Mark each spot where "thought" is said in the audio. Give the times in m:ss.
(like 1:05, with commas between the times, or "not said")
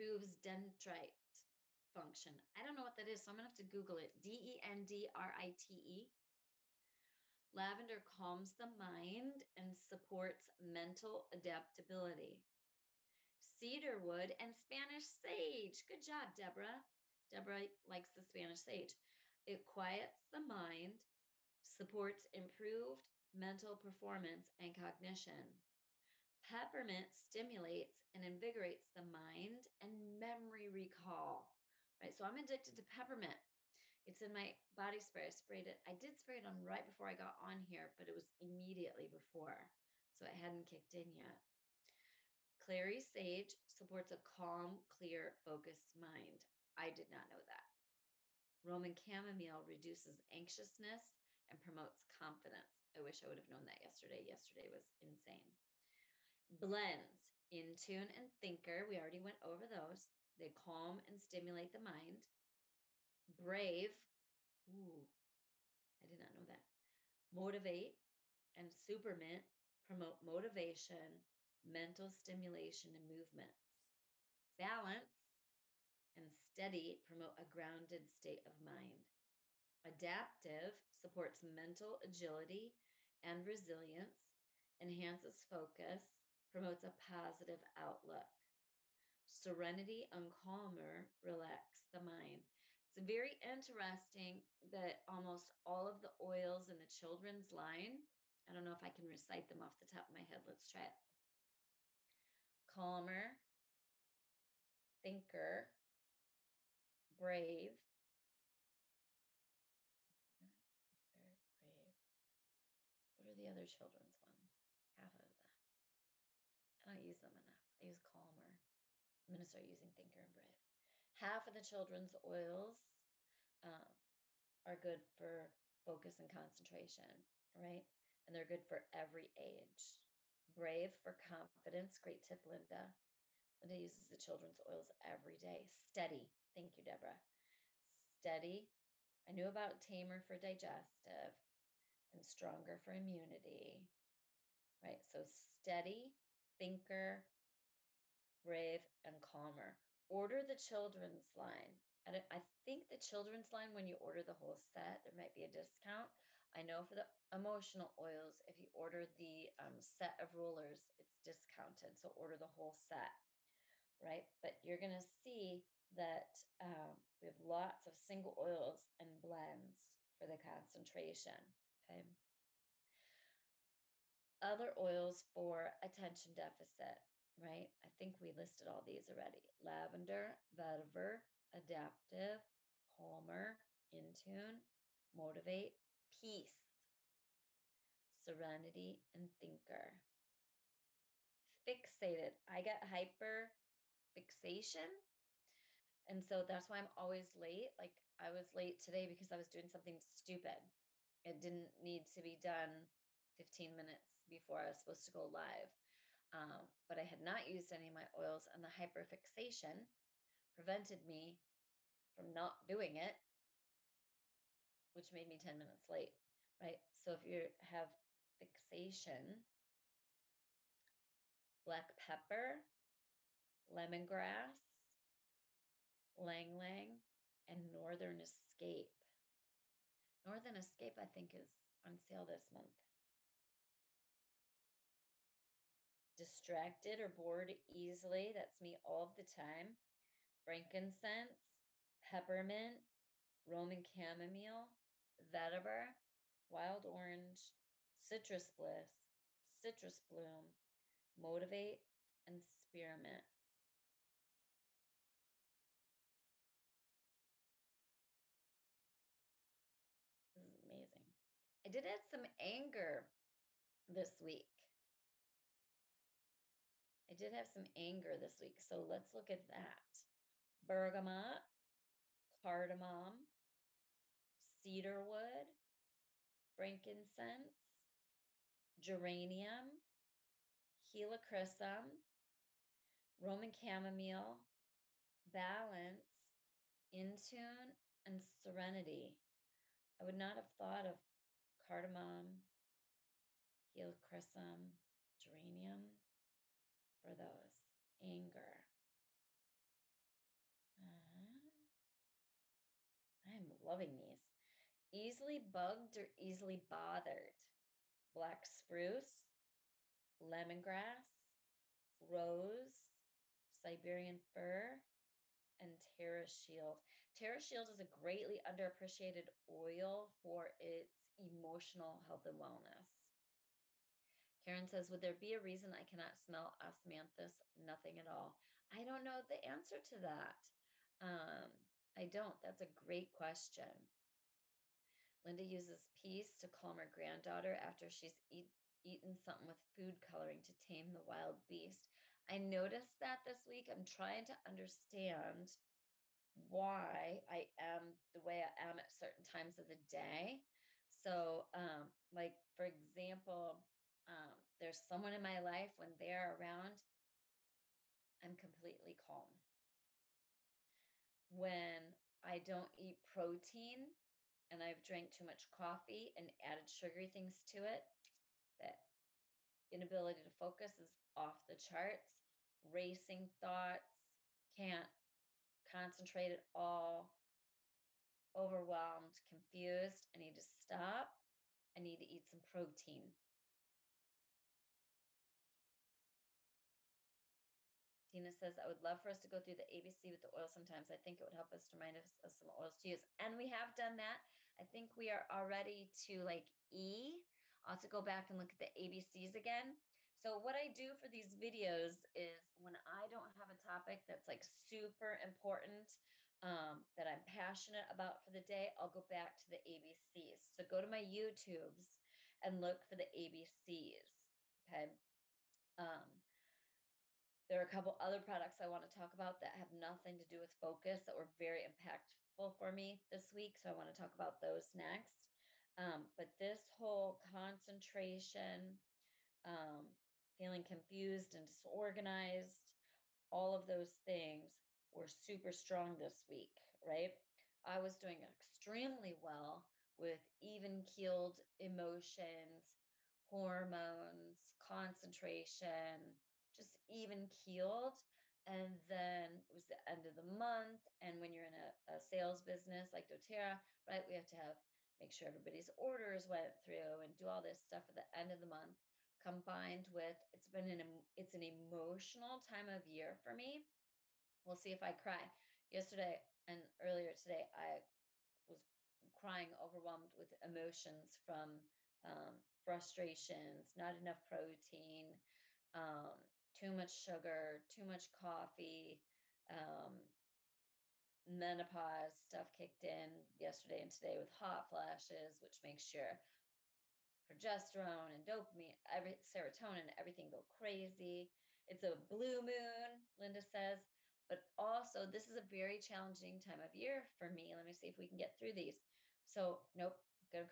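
4:50, 6:13.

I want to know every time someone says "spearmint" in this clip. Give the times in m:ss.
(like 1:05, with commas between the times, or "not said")
1:08, 4:12.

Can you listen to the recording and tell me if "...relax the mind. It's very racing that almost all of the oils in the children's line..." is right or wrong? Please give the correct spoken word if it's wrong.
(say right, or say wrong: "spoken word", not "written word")
wrong: "interesting", not "racing".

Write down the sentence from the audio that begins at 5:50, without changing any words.
So, um, like for example, um, there's someone in my life when they're around, I'm completely calm.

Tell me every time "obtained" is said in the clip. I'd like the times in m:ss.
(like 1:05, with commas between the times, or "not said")
not said.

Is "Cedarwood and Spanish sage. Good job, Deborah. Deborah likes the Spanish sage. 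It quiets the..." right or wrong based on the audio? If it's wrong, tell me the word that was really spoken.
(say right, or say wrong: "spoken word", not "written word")
right.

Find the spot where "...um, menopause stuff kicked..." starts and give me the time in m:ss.
7:59.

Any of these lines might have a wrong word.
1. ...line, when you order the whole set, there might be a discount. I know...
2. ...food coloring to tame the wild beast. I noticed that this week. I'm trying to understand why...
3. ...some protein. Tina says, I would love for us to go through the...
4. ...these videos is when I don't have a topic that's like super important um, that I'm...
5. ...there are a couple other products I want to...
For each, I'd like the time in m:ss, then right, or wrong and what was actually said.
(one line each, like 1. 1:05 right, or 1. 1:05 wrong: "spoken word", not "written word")
1. 2:33 right
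2. 5:39 right
3. 6:22 right
4. 6:41 right
5. 6:57 right.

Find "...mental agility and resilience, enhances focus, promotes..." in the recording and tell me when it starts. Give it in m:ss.
1:21.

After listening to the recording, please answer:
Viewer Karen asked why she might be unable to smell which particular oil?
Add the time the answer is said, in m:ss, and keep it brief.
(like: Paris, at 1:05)
Osmanthus, at 5:26.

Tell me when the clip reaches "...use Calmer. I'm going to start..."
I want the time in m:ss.
1:57.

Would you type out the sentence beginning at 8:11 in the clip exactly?
It's a blue moon, Linda says, but also this is a very challenging time of year for me.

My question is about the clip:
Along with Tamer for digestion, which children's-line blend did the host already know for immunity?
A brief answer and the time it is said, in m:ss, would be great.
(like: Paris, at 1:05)
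Stronger, at 2:22.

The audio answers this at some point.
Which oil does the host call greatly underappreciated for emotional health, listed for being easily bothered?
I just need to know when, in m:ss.
5:17.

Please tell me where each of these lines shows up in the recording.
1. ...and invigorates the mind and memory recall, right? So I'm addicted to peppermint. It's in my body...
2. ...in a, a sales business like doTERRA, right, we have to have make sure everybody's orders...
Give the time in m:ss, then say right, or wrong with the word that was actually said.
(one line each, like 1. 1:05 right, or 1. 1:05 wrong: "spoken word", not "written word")
1. 0:28 right
2. 7:31 right.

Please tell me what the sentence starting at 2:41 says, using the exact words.
So order the whole set, right?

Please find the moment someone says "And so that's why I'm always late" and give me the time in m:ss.
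3:16.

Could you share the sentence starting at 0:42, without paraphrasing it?
Clary Sage supports a calm, clear, focused mind.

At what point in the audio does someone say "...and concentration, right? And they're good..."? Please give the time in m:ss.
2:06.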